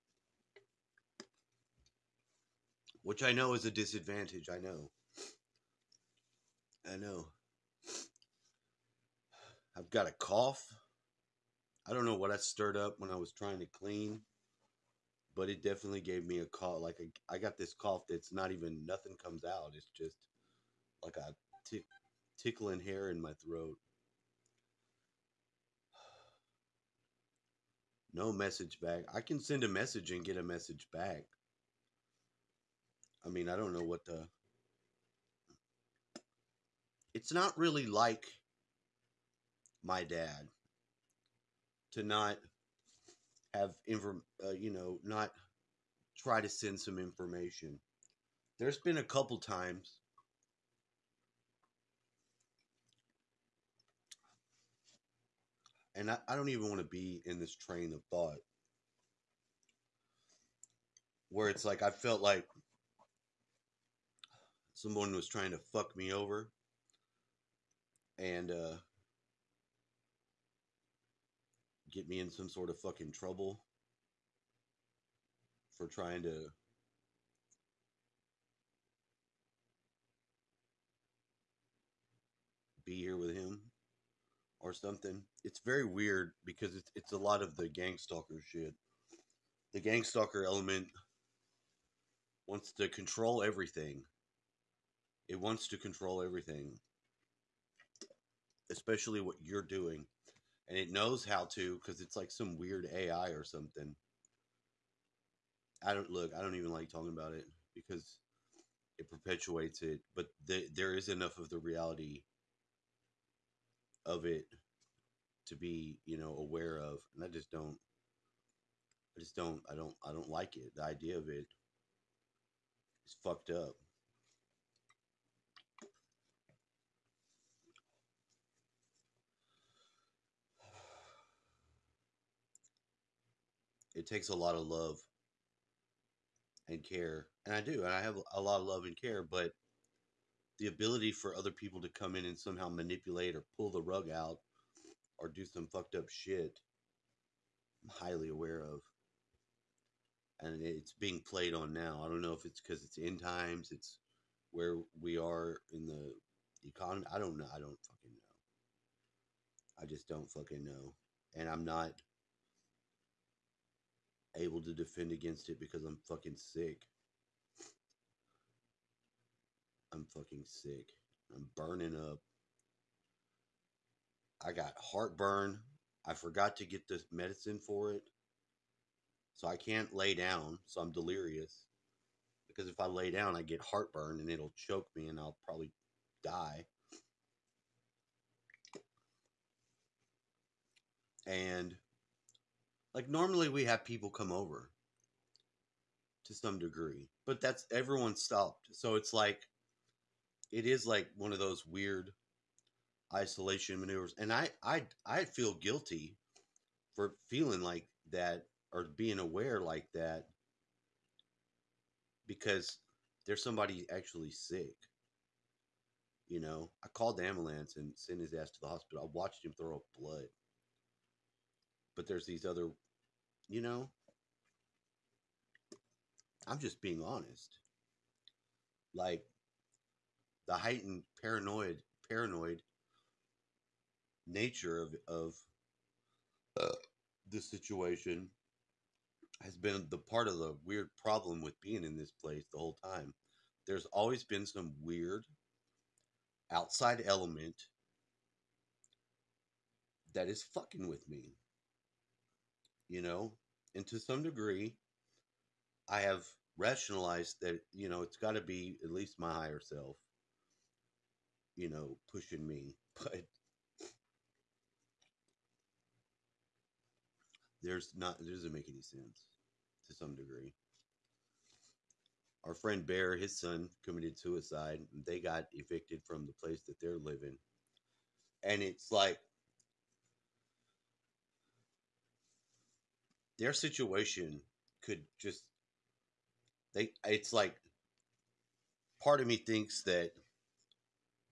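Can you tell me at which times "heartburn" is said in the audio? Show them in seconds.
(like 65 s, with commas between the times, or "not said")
174 s, 183 s.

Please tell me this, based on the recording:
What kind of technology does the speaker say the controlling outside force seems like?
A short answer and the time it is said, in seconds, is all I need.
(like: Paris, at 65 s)
AI, at 102 s.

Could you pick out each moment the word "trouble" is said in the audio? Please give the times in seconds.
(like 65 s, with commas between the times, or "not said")
73 s.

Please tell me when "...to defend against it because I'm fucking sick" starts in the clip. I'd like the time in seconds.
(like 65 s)
164 s.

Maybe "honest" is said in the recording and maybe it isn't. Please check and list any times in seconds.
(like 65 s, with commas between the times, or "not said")
227 s.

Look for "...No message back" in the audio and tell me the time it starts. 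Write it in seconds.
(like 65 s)
28 s.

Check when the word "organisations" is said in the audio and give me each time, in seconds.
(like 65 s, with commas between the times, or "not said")
not said.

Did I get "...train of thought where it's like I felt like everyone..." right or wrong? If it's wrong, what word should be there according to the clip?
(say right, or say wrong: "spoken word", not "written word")
wrong: "someone", not "everyone".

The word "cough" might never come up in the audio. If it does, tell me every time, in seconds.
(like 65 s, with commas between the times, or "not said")
10 s, 17 s.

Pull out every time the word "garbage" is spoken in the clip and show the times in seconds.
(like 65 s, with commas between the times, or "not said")
not said.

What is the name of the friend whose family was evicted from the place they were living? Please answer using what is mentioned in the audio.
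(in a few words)
Bear.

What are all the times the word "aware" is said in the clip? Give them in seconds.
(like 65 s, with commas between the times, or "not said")
116 s, 148 s, 209 s.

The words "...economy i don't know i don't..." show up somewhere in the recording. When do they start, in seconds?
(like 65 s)
156 s.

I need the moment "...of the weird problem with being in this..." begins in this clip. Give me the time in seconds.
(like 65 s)
240 s.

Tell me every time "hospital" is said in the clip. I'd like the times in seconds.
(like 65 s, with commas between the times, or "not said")
218 s.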